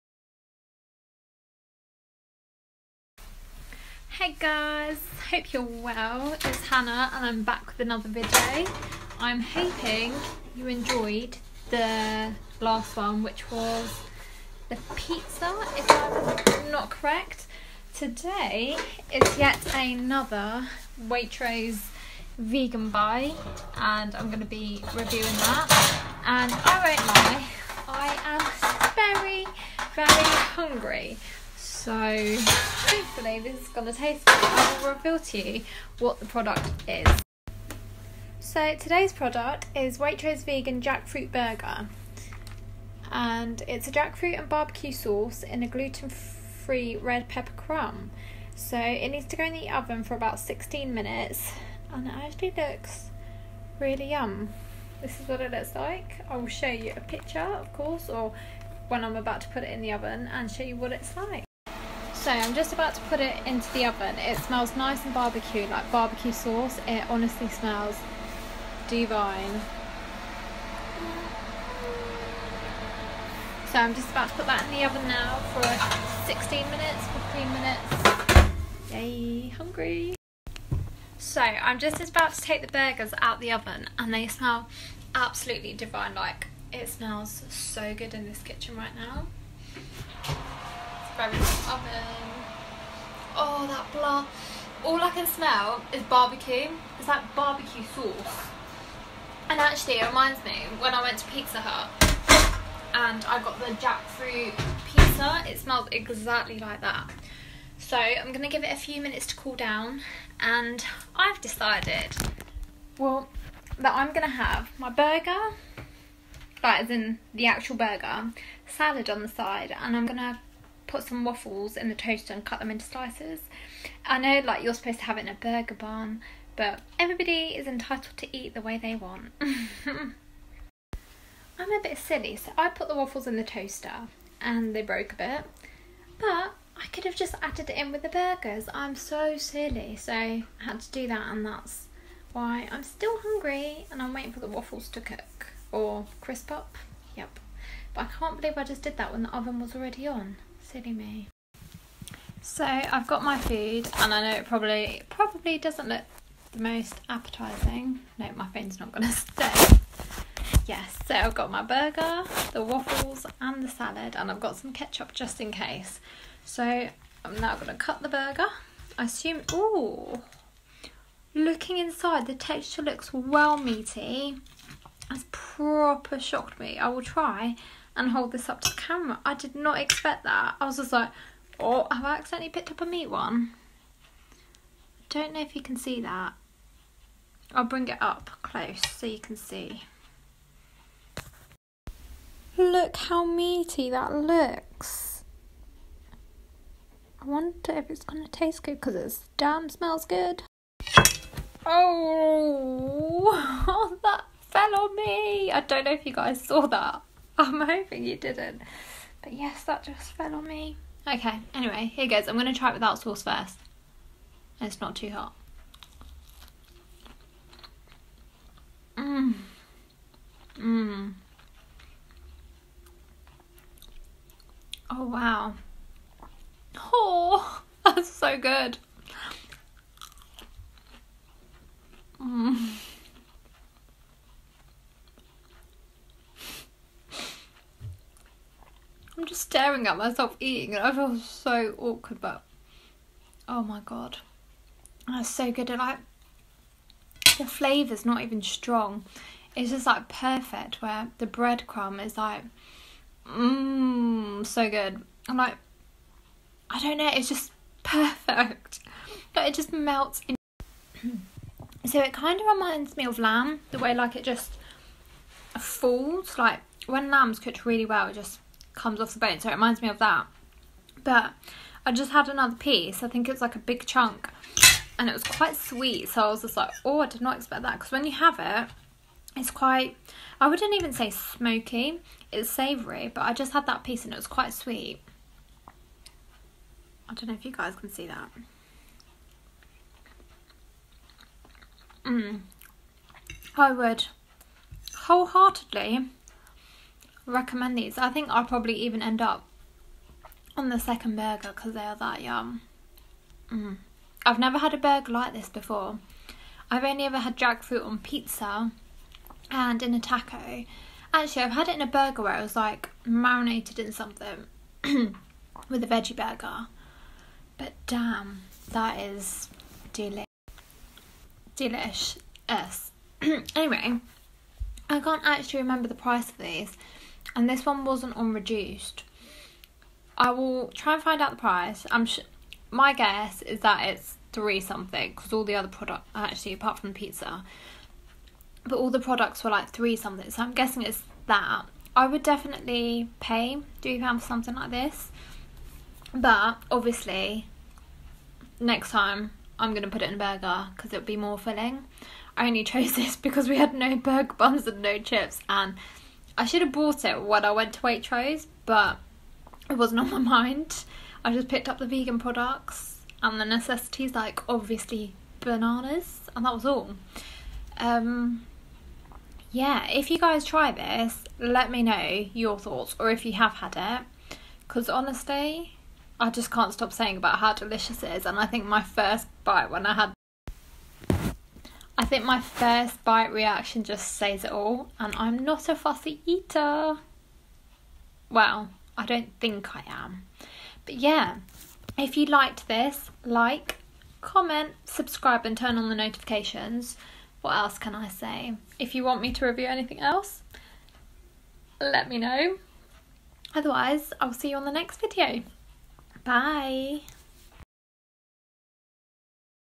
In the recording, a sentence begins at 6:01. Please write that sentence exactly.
I just picked up the vegan products and the necessities, like obviously bananas, and that was all.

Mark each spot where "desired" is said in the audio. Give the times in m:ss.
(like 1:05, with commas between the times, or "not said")
not said.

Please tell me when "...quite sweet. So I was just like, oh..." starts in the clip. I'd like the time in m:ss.
4:35.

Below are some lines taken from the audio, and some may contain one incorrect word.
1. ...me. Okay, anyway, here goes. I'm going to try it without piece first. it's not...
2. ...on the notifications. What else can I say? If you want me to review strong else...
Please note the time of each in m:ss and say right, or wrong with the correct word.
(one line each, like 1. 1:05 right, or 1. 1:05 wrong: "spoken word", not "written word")
1. 3:30 wrong: "sauce", not "piece"
2. 6:35 wrong: "anything", not "strong".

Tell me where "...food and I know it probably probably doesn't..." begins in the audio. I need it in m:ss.
2:33.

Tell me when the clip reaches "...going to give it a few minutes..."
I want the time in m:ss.
1:48.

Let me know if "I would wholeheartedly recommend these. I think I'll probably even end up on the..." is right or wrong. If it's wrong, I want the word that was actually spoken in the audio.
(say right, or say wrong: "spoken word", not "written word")
right.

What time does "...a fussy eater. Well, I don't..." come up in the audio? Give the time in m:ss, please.
6:25.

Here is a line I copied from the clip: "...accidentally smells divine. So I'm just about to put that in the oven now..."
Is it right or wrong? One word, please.
wrong.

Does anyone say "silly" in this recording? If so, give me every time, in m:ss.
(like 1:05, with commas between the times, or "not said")
2:11, 2:19, 2:30.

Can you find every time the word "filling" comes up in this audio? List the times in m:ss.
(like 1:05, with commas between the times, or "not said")
5:51.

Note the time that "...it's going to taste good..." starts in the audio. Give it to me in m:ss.
3:17.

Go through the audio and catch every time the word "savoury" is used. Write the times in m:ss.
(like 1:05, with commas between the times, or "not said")
4:42.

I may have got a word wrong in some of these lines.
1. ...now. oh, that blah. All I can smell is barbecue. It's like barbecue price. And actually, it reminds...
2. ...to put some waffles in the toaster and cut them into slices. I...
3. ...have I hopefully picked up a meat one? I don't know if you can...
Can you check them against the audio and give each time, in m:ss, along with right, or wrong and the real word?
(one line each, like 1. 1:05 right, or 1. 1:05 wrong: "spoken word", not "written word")
1. 1:28 wrong: "sauce", not "price"
2. 2:00 right
3. 3:01 wrong: "accidentally", not "hopefully".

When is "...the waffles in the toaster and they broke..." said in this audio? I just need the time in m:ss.
2:12.